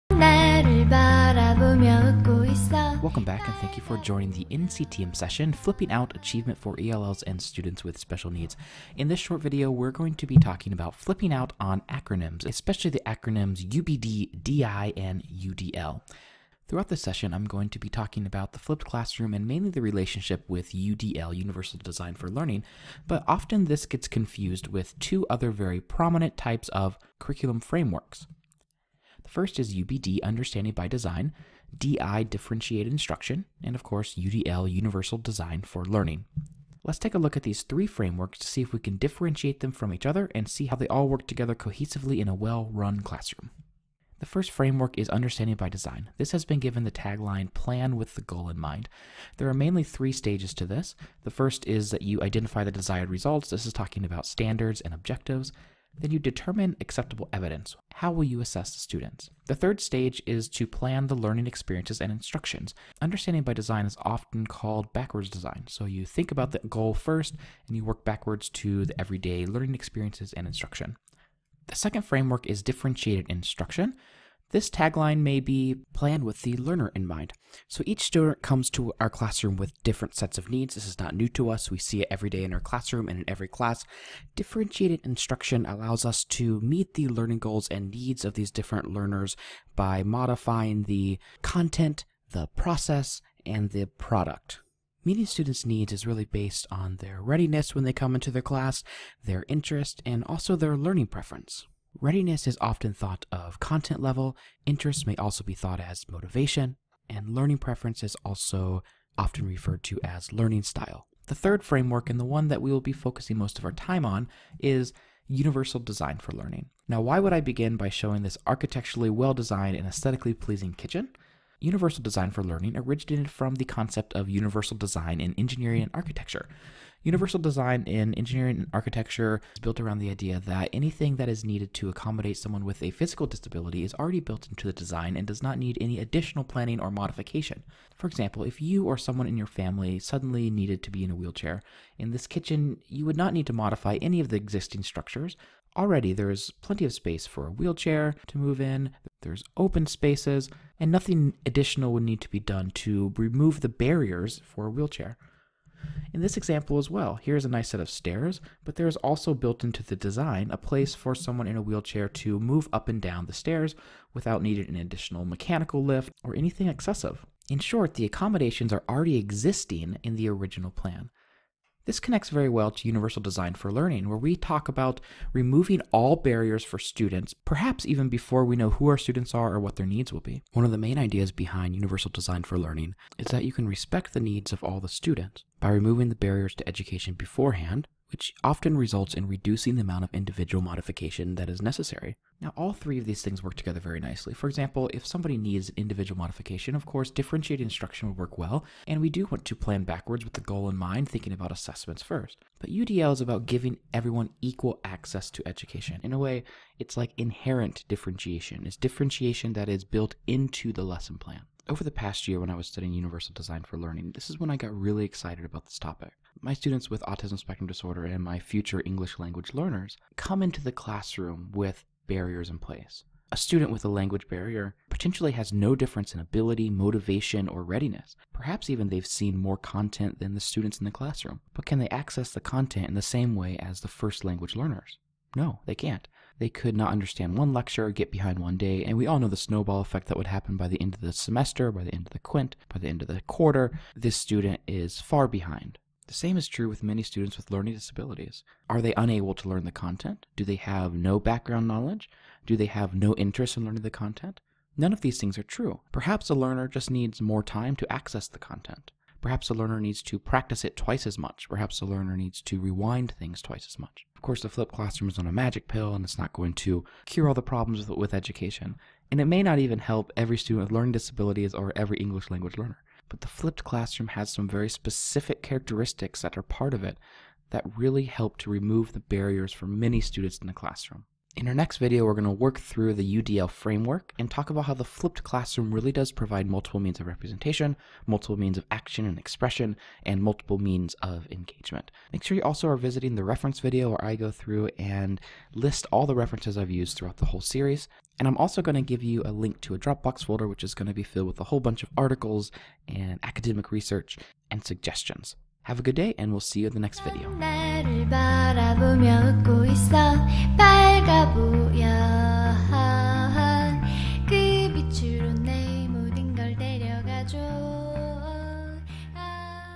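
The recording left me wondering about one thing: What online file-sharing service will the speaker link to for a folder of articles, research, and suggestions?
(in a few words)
Dropbox.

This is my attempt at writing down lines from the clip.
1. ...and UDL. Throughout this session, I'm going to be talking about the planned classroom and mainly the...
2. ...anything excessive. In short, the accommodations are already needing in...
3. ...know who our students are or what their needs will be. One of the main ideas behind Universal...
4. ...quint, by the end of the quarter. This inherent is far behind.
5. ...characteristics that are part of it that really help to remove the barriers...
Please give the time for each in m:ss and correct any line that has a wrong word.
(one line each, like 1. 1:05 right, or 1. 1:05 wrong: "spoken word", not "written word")
1. 0:14 wrong: "flipped", not "planned"
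2. 2:46 wrong: "existing", not "needing"
3. 2:58 right
4. 4:02 wrong: "student", not "inherent"
5. 4:35 right.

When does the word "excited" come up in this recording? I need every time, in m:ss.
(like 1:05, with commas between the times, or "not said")
3:35.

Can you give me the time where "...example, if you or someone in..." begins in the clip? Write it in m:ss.
2:18.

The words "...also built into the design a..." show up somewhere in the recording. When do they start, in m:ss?
2:38.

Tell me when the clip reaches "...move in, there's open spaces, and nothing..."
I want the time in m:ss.
2:28.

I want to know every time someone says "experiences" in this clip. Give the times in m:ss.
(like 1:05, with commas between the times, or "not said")
1:01, 1:09.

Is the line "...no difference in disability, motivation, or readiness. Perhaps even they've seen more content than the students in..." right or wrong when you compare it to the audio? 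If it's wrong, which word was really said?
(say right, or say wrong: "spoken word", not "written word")
wrong: "ability", not "disability".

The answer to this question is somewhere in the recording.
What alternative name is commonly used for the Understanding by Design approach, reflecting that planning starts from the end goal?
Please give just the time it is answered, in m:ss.
1:04.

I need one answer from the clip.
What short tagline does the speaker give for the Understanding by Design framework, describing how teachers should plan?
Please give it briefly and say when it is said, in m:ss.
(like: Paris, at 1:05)
Plan with the goal in mind, at 0:47.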